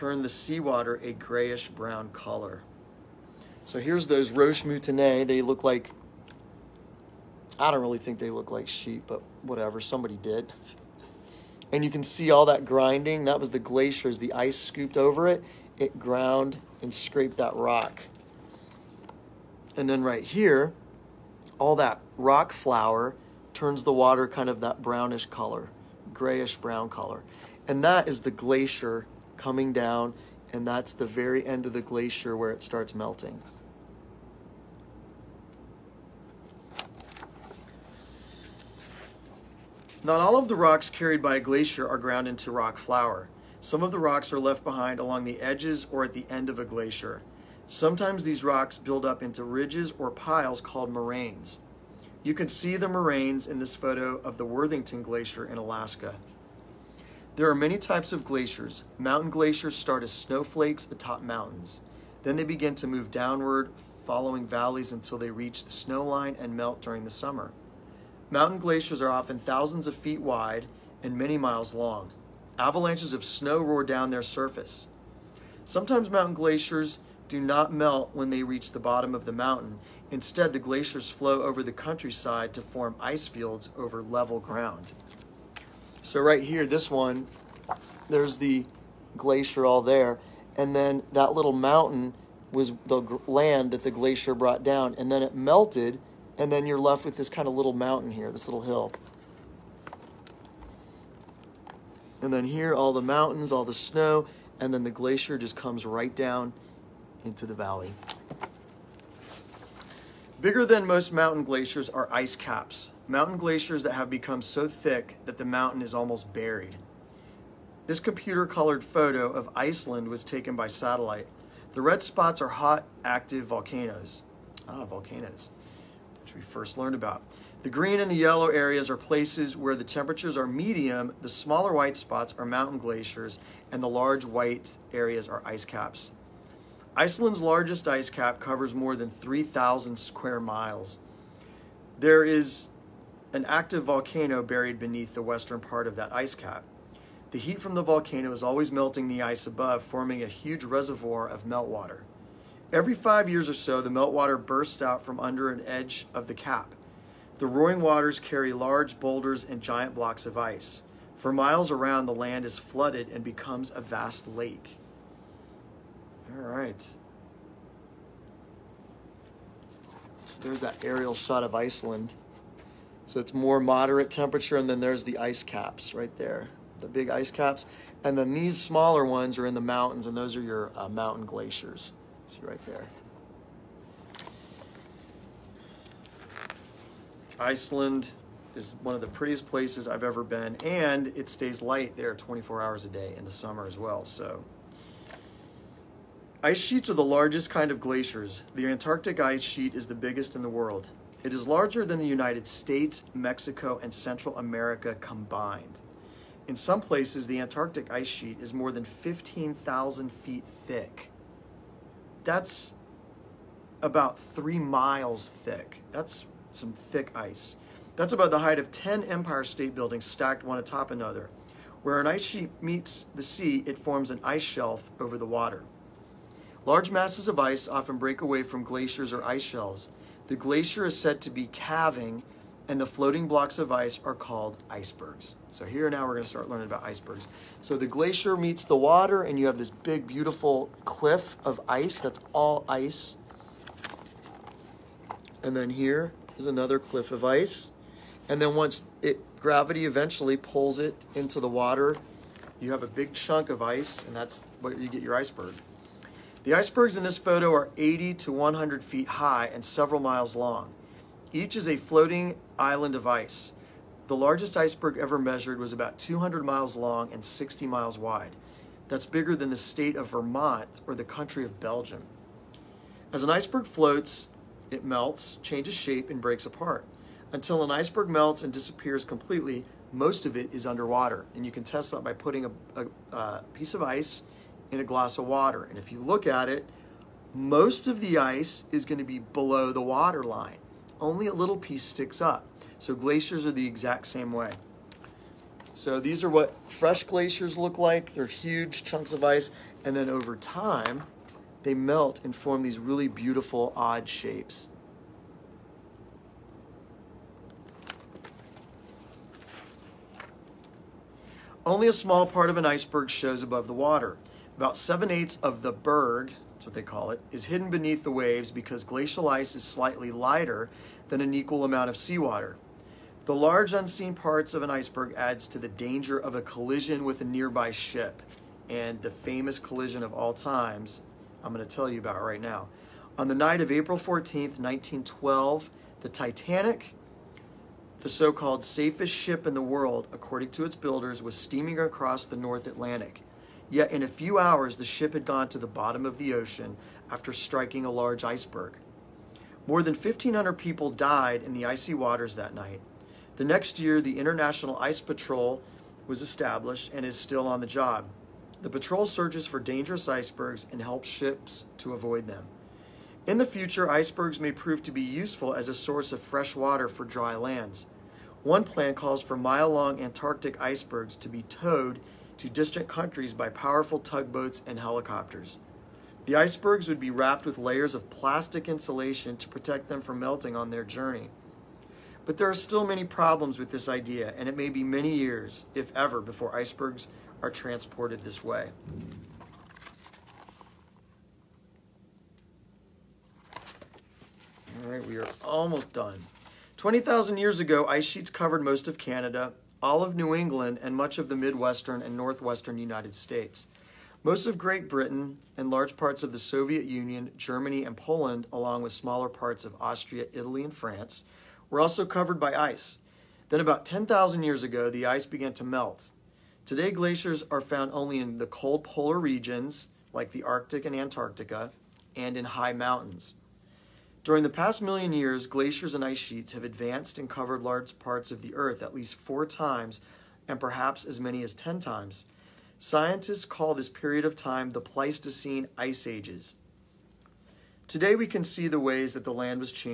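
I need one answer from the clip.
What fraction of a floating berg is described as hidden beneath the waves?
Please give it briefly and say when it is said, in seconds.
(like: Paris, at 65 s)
7/8, at 314 s.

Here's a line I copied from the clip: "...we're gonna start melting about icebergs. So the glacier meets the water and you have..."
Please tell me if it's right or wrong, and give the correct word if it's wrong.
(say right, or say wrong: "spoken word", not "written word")
wrong: "learning", not "melting".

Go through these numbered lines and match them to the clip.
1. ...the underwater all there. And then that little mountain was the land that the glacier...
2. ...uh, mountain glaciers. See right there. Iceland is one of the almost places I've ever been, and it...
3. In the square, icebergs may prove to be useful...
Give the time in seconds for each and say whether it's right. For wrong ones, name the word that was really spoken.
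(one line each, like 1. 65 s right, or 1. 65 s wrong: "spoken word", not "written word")
1. 88 s wrong: "glacier", not "underwater"
2. 180 s wrong: "prettiest", not "almost"
3. 363 s wrong: "future", not "square".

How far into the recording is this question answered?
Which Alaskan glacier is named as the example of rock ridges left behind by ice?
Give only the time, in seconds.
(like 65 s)
54 s.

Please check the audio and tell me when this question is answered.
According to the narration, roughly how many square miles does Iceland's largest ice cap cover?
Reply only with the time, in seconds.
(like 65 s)
138 s.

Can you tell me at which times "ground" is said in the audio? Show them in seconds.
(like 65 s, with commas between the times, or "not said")
15 s, 41 s, 84 s.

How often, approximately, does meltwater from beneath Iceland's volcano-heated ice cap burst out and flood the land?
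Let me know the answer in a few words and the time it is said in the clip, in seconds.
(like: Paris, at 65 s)
every five years, at 152 s.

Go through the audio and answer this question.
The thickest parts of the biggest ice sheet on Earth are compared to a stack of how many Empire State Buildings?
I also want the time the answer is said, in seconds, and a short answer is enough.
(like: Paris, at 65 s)
10, at 218 s.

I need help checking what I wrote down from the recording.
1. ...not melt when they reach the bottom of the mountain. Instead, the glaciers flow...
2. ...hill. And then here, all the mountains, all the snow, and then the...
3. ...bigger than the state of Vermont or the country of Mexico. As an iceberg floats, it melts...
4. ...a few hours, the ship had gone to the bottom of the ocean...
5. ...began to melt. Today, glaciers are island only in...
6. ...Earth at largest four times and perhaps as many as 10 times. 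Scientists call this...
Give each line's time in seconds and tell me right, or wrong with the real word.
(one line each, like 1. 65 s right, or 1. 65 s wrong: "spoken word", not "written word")
1. 77 s right
2. 98 s right
3. 269 s wrong: "Belgium", not "Mexico"
4. 344 s right
5. 415 s wrong: "found", not "island"
6. 428 s wrong: "least", not "largest".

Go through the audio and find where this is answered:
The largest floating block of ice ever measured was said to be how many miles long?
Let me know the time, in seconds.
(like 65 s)
265 s.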